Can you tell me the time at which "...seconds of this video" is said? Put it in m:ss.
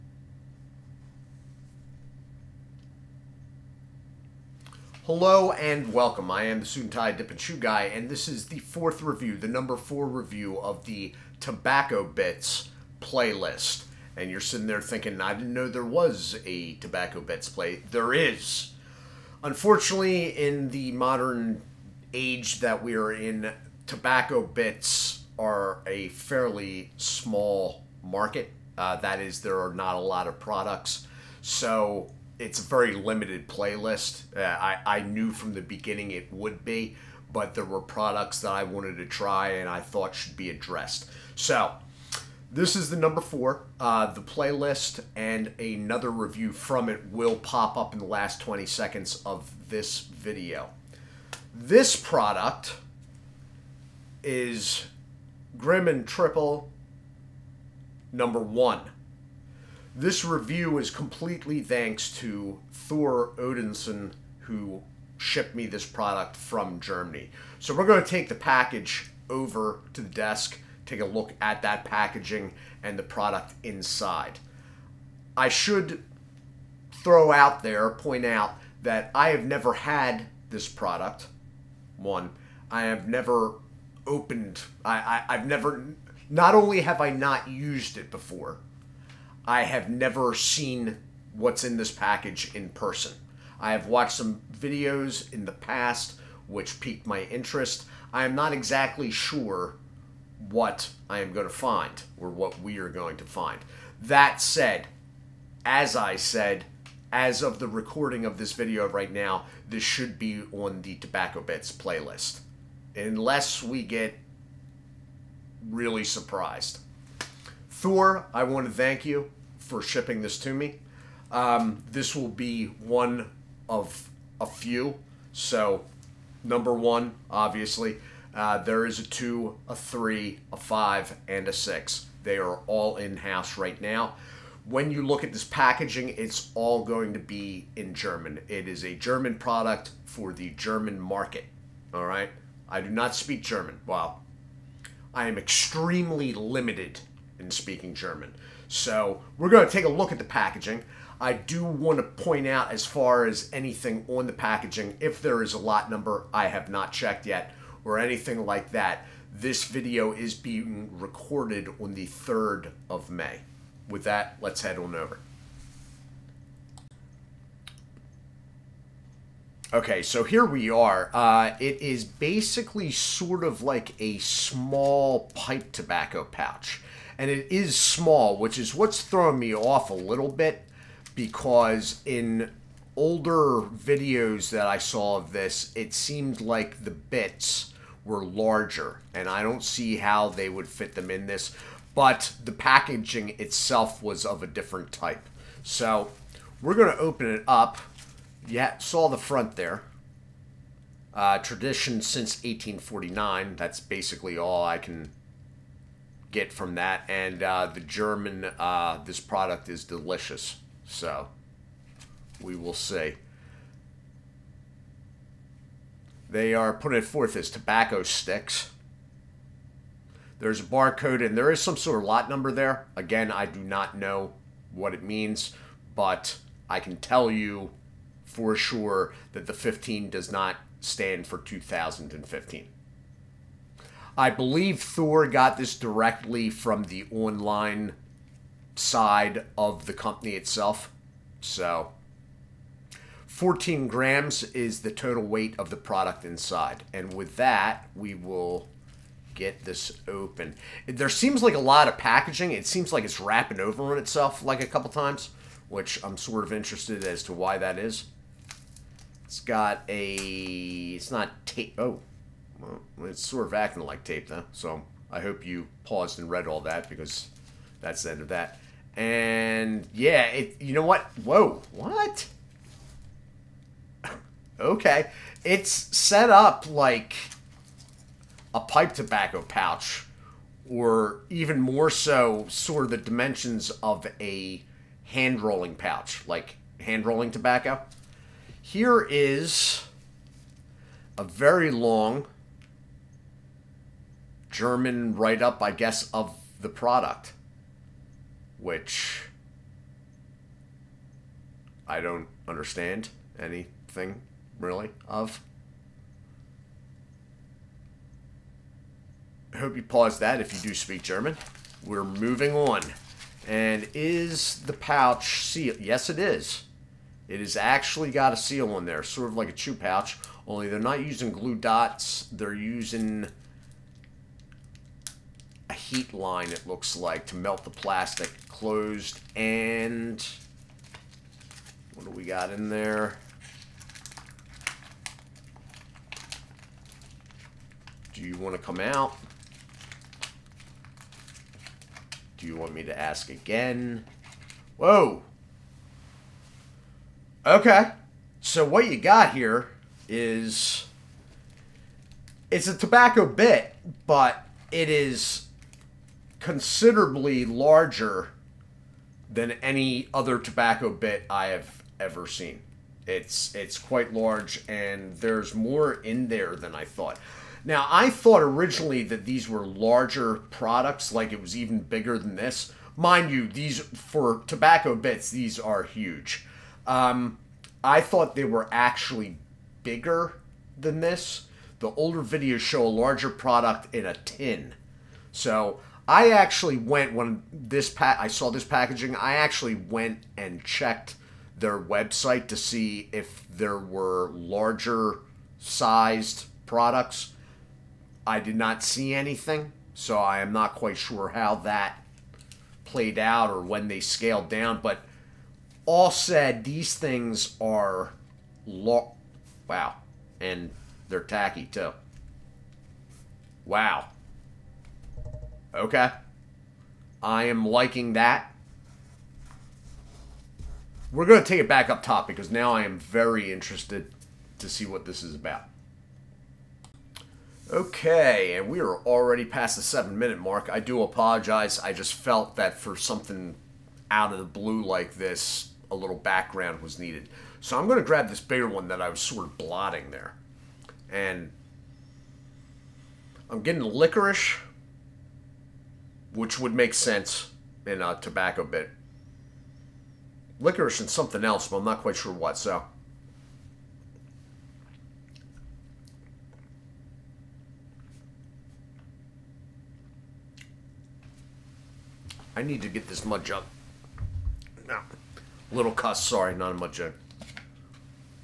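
0:48.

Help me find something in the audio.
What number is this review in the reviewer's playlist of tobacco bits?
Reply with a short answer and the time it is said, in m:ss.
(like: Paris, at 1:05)
4, at 0:09.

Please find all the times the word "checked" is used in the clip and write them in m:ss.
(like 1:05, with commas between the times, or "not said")
2:36, 6:30.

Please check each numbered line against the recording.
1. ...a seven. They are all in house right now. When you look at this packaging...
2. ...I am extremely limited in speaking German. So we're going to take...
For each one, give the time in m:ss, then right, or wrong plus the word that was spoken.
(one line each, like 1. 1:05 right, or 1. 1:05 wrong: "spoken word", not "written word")
1. 2:11 wrong: "six", not "seven"
2. 2:25 right.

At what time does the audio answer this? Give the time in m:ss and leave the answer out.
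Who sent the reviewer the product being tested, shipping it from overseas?
1:02.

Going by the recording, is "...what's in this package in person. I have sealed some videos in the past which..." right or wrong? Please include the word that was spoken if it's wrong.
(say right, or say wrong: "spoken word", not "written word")
wrong: "watched", not "sealed".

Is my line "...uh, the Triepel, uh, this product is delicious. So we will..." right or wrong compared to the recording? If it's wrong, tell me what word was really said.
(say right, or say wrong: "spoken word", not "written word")
wrong: "German", not "Triepel".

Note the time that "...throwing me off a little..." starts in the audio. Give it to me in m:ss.
2:59.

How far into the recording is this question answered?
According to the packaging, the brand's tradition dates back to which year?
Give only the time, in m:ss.
3:22.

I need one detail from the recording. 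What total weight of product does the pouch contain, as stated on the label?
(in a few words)
14 grams.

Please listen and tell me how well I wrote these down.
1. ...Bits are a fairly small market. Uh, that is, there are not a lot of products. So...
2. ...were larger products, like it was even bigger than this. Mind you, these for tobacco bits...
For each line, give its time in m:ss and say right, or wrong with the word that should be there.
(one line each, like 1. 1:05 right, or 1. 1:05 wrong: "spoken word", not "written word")
1. 0:24 right
2. 6:09 right.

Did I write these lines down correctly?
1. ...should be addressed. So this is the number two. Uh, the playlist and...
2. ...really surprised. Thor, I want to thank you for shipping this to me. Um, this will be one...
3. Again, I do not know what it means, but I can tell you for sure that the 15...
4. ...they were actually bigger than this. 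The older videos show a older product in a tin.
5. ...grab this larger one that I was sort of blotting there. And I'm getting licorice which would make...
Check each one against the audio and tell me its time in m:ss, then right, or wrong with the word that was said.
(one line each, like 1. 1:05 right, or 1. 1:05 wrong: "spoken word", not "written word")
1. 0:40 wrong: "four", not "two"
2. 1:55 right
3. 3:42 right
4. 6:18 wrong: "larger", not "older"
5. 7:18 wrong: "bigger", not "larger".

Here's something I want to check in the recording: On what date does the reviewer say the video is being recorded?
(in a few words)
3rd of May.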